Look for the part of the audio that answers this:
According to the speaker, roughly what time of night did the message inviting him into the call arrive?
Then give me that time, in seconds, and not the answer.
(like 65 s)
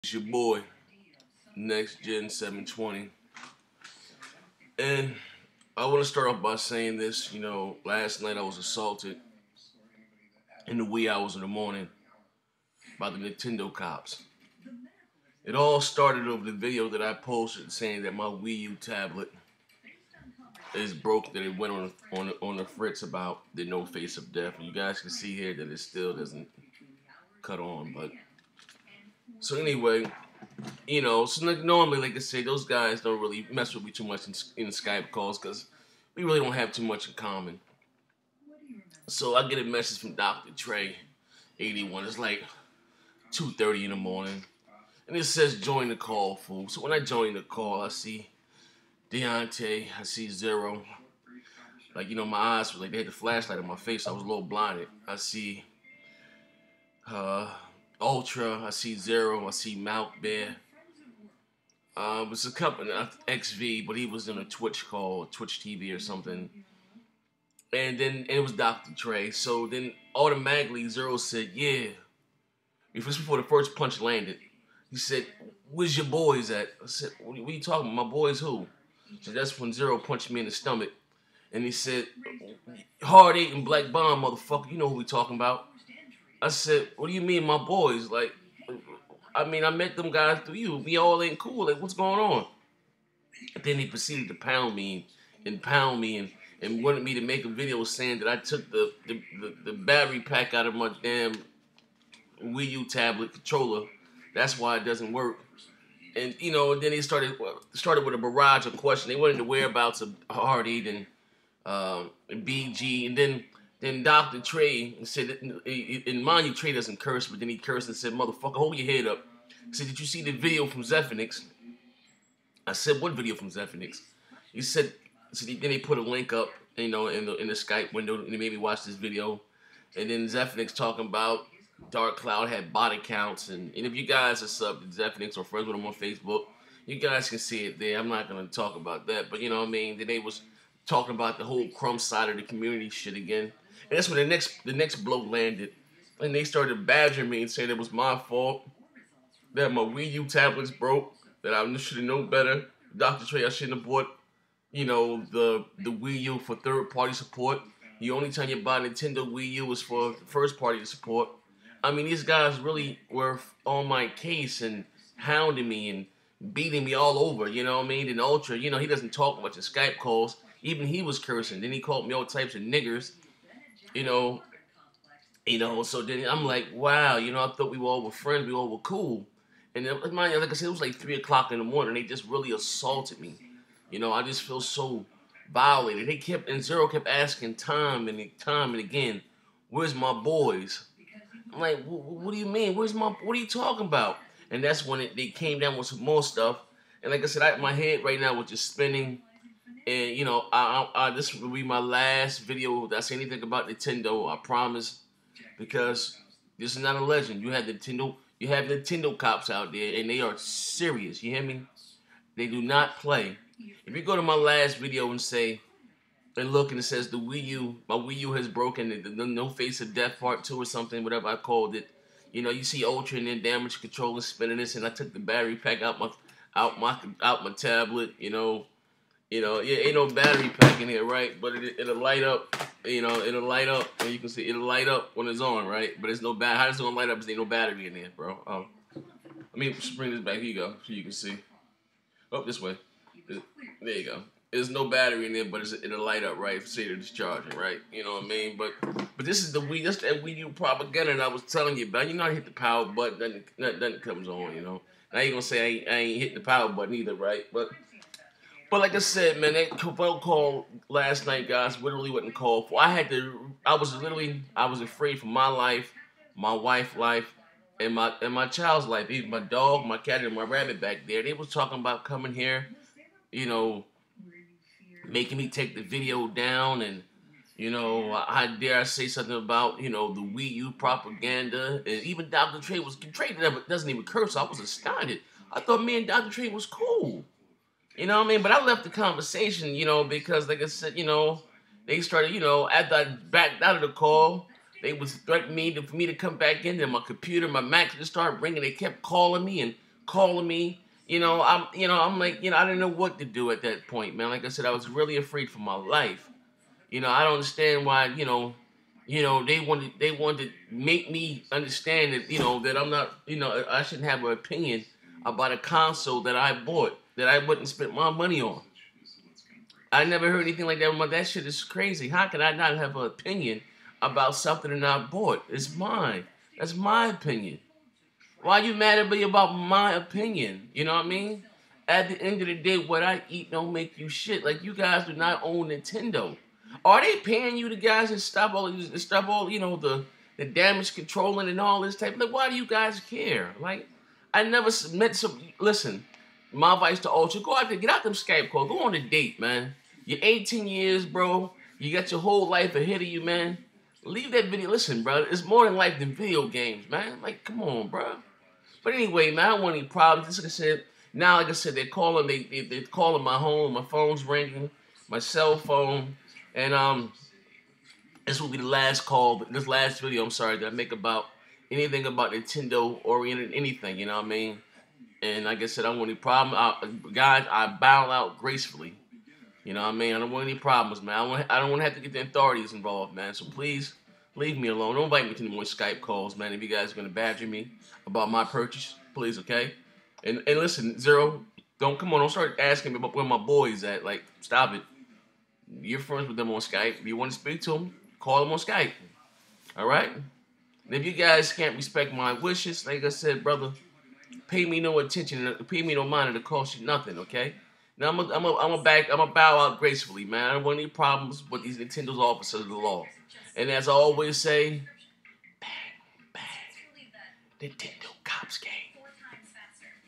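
43 s.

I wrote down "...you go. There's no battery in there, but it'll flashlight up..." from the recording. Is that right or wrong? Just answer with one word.
wrong.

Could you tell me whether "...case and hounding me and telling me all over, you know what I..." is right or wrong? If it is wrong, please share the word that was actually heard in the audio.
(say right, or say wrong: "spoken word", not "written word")
wrong: "beating", not "telling".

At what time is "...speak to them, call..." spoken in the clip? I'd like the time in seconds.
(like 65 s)
397 s.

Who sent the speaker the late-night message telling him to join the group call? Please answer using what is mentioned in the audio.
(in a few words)
Dr. Trey 81.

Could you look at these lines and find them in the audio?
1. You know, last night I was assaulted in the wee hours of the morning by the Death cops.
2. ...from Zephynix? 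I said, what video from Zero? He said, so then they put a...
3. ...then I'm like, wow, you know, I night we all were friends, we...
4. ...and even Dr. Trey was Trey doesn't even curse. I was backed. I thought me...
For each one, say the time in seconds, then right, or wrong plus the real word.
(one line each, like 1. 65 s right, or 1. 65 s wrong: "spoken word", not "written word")
1. 7 s wrong: "Nintendo", not "Death"
2. 120 s wrong: "Zephinix", not "Zero"
3. 176 s wrong: "thought", not "night"
4. 281 s wrong: "astounded", not "backed".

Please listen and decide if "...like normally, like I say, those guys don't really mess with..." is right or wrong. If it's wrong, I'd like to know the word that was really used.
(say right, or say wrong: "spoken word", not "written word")
right.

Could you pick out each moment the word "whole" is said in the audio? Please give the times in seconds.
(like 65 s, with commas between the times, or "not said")
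141 s, 352 s.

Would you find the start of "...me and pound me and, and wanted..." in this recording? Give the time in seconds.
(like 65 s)
94 s.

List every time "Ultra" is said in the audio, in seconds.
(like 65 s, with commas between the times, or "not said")
58 s, 168 s, 222 s, 347 s.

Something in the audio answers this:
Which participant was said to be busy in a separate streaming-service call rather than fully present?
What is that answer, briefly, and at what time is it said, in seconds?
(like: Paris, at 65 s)
XV, at 63 s.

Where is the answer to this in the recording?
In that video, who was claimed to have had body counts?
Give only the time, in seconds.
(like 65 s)
131 s.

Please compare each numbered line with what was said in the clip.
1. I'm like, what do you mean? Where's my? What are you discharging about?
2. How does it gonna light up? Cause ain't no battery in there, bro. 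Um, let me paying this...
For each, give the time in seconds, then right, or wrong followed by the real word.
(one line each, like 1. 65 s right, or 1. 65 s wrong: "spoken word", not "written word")
1. 191 s wrong: "talking", not "discharging"
2. 236 s wrong: "bring", not "paying".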